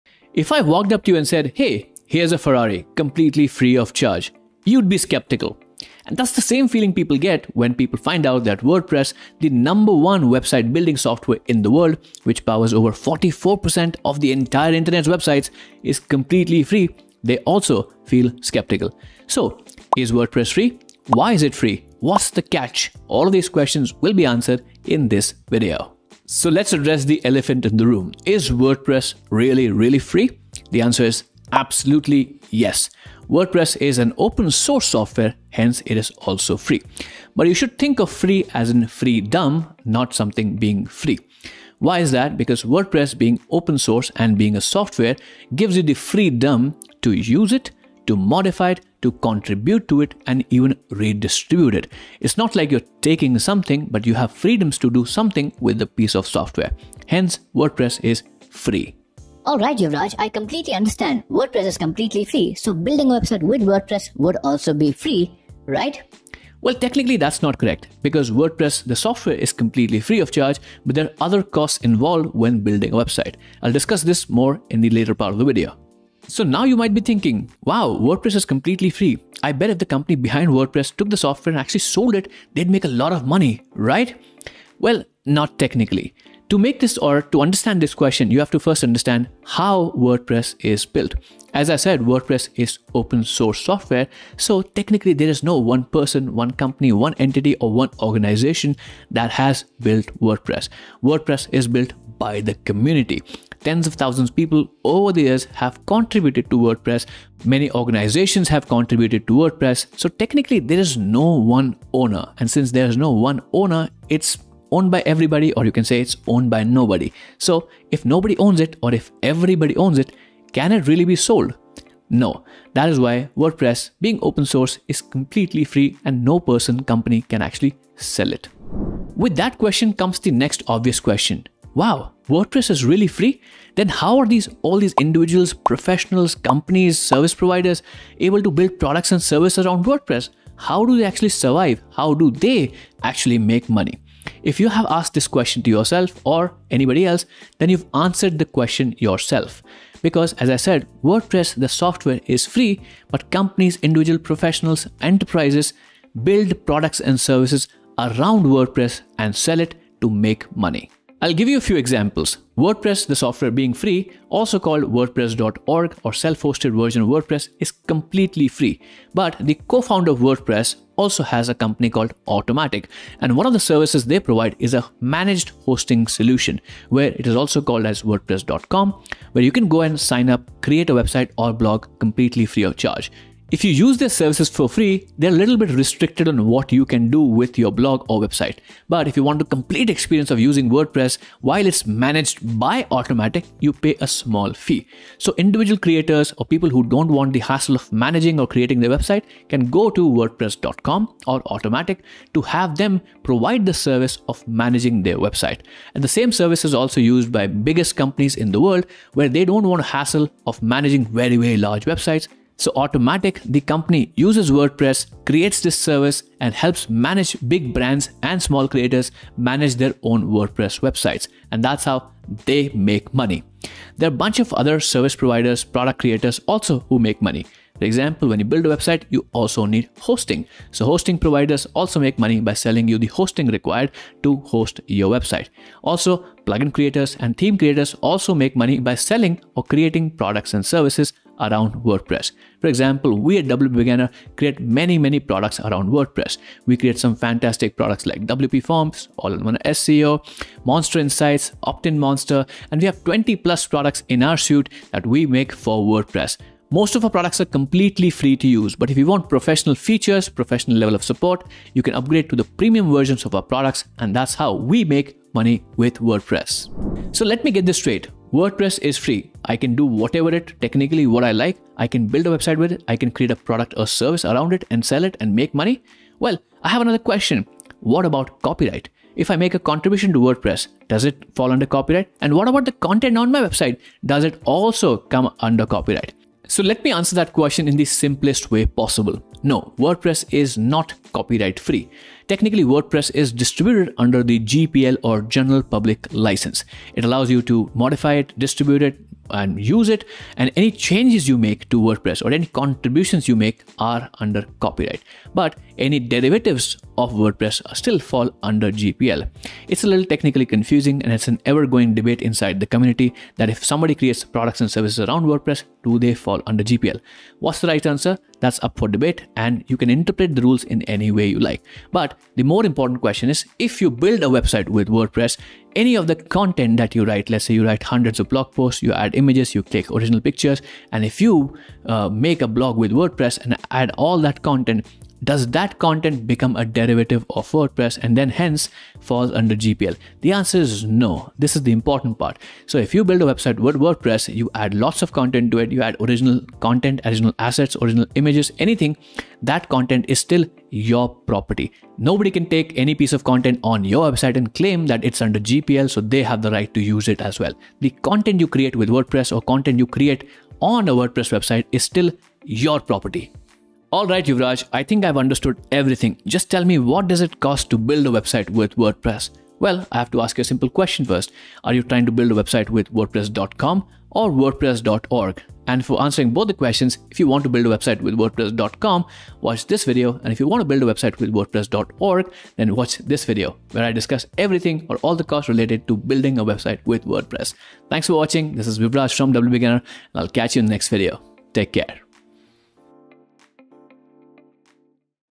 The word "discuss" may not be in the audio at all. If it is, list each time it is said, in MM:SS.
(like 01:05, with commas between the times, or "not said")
01:13, 06:23.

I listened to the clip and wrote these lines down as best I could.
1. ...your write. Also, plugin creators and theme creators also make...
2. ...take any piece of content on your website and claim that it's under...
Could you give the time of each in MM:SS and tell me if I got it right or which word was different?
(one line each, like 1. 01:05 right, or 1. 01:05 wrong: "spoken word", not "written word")
1. 03:54 wrong: "website", not "write"
2. 05:52 right.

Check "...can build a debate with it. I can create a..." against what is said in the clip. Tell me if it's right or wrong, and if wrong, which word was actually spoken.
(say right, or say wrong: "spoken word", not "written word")
wrong: "website", not "debate".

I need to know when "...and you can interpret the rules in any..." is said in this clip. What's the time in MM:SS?
05:19.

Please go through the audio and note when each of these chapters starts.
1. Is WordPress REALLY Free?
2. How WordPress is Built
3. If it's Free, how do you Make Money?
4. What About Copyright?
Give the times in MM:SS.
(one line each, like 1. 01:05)
1. 00:26
2. 01:16
3. 02:12
4. 04:27.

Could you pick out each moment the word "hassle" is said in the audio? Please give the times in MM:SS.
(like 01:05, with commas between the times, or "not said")
03:17, 03:29.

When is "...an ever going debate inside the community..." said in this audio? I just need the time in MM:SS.
05:11.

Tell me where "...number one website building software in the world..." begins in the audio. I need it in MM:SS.
00:09.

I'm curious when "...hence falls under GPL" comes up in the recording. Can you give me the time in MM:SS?
05:38.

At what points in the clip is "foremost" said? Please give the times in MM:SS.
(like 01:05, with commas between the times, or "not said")
not said.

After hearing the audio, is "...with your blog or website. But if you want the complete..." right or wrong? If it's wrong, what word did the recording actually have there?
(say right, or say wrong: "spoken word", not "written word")
right.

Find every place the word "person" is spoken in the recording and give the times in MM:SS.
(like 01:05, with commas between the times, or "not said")
01:35, 02:06.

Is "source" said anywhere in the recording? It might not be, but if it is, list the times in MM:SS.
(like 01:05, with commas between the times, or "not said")
00:34, 00:43, 01:33, 02:04.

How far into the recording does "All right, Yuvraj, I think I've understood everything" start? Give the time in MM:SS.
06:03.